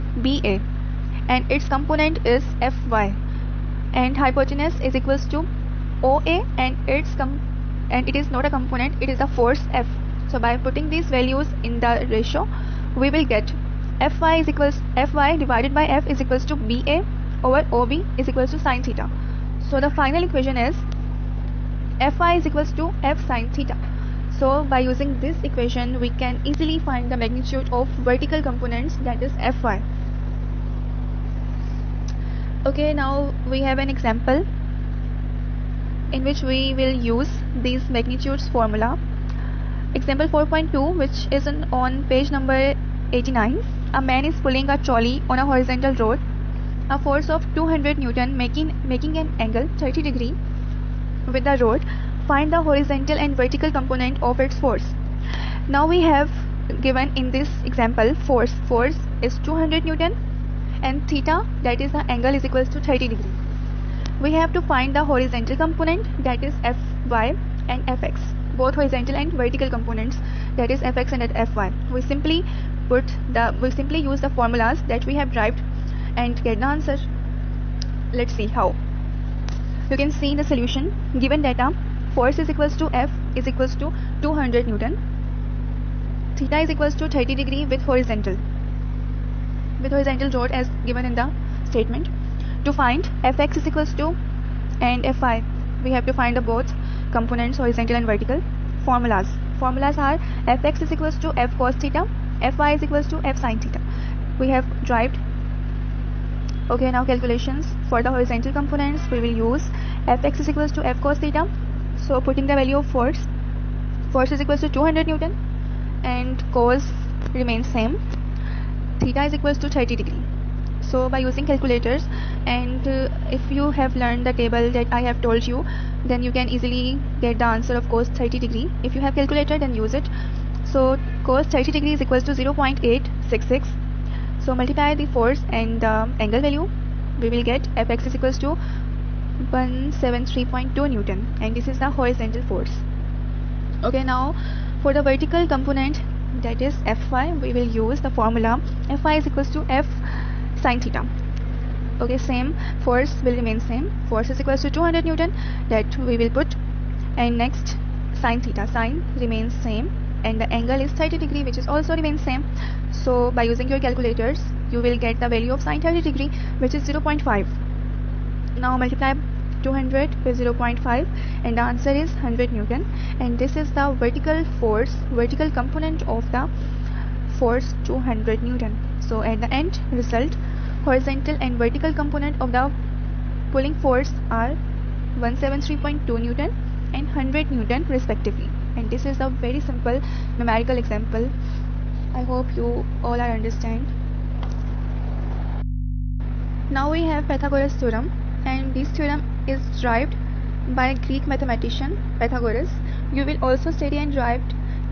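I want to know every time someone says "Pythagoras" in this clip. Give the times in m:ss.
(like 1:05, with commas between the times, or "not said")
3:17, 3:22.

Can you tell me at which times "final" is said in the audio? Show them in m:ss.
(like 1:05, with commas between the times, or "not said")
0:19.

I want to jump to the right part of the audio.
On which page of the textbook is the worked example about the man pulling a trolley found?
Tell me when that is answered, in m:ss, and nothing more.
0:43.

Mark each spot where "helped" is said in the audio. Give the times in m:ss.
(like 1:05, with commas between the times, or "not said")
not said.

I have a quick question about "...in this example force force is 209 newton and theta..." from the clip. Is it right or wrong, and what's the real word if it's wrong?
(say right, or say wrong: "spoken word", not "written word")
wrong: "200", not "209".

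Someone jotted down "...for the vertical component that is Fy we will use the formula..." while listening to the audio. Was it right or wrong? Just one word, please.
right.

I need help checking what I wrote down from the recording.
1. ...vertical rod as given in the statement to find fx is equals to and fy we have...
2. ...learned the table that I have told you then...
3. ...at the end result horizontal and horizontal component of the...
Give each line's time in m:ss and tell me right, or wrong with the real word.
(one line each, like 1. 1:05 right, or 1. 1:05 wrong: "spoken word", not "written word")
1. 1:29 wrong: "horizontal", not "vertical"
2. 2:04 right
3. 2:59 wrong: "vertical", not "horizontal".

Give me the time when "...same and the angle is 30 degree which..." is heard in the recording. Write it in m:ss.
2:39.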